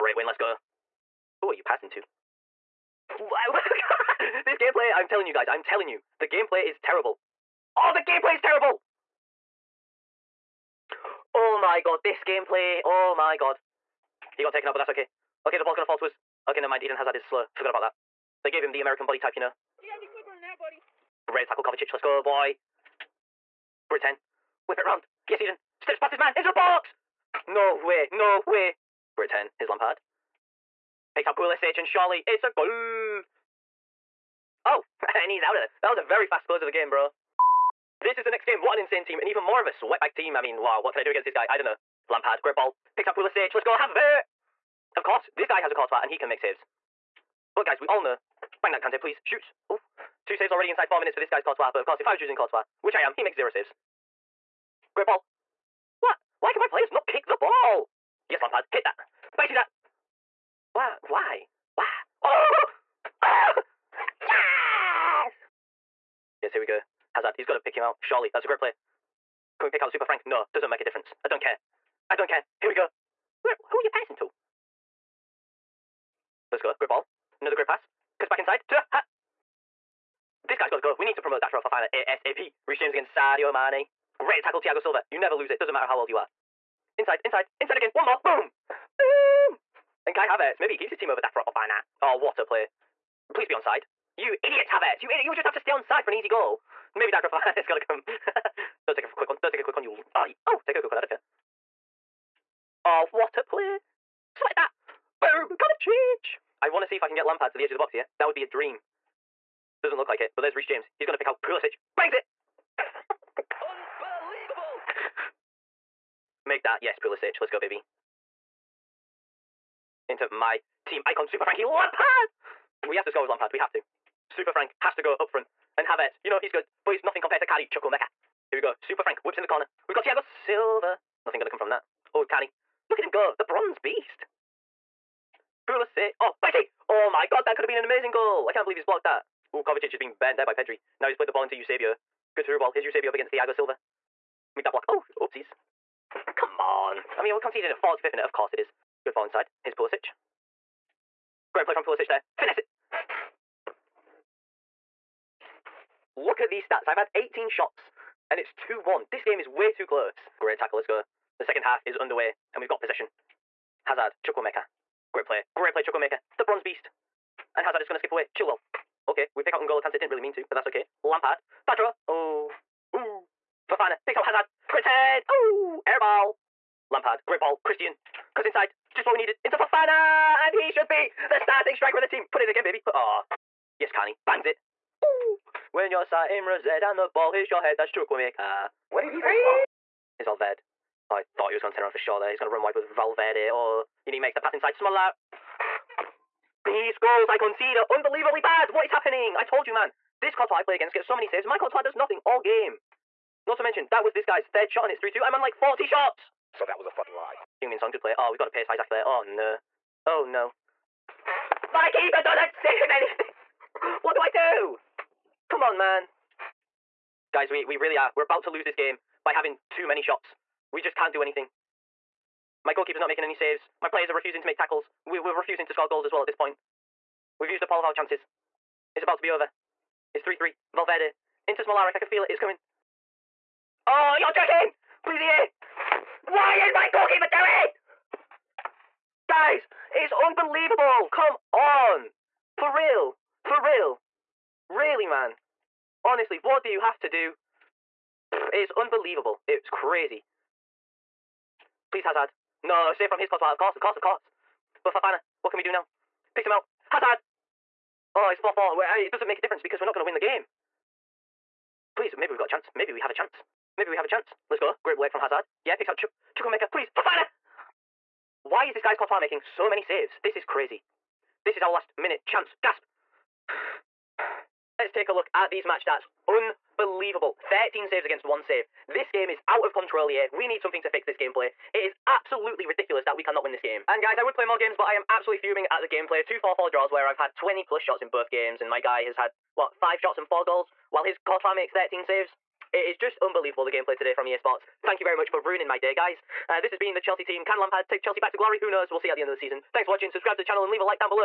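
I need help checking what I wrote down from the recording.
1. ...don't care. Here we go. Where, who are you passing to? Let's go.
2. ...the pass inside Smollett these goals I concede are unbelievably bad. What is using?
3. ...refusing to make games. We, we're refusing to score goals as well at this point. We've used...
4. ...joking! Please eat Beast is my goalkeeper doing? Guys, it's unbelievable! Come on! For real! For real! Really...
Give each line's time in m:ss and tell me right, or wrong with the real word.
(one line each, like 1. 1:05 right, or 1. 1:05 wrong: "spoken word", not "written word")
1. 1:12 right
2. 3:14 wrong: "happening", not "using"
3. 3:44 wrong: "tackles", not "games"
4. 3:54 wrong: "Why", not "Beast".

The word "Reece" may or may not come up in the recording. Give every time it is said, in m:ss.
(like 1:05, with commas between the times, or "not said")
1:22, 1:50.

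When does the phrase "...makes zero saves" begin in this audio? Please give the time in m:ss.
0:53.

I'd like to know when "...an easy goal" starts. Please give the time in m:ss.
1:36.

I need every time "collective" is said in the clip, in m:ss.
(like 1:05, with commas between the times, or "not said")
not said.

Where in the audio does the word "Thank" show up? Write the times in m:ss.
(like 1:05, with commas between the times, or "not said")
4:54, 4:59.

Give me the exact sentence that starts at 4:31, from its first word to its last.
This is our last minute chance.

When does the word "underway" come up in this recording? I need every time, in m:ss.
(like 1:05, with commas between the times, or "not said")
2:41.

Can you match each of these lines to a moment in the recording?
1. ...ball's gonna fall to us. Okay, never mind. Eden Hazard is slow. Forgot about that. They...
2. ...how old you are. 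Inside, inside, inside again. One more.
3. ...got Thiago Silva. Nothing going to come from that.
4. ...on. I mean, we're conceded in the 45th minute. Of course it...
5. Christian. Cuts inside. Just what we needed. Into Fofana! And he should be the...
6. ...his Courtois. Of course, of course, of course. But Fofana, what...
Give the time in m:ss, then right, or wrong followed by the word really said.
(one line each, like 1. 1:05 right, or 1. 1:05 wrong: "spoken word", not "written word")
1. 0:15 right
2. 1:25 right
3. 2:09 right
4. 2:26 right
5. 2:57 right
6. 4:13 right.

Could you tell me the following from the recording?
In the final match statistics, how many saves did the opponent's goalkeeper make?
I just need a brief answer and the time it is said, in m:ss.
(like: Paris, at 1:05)
13, at 4:37.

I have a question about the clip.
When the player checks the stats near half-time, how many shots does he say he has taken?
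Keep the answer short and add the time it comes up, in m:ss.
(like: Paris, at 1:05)
18, at 2:36.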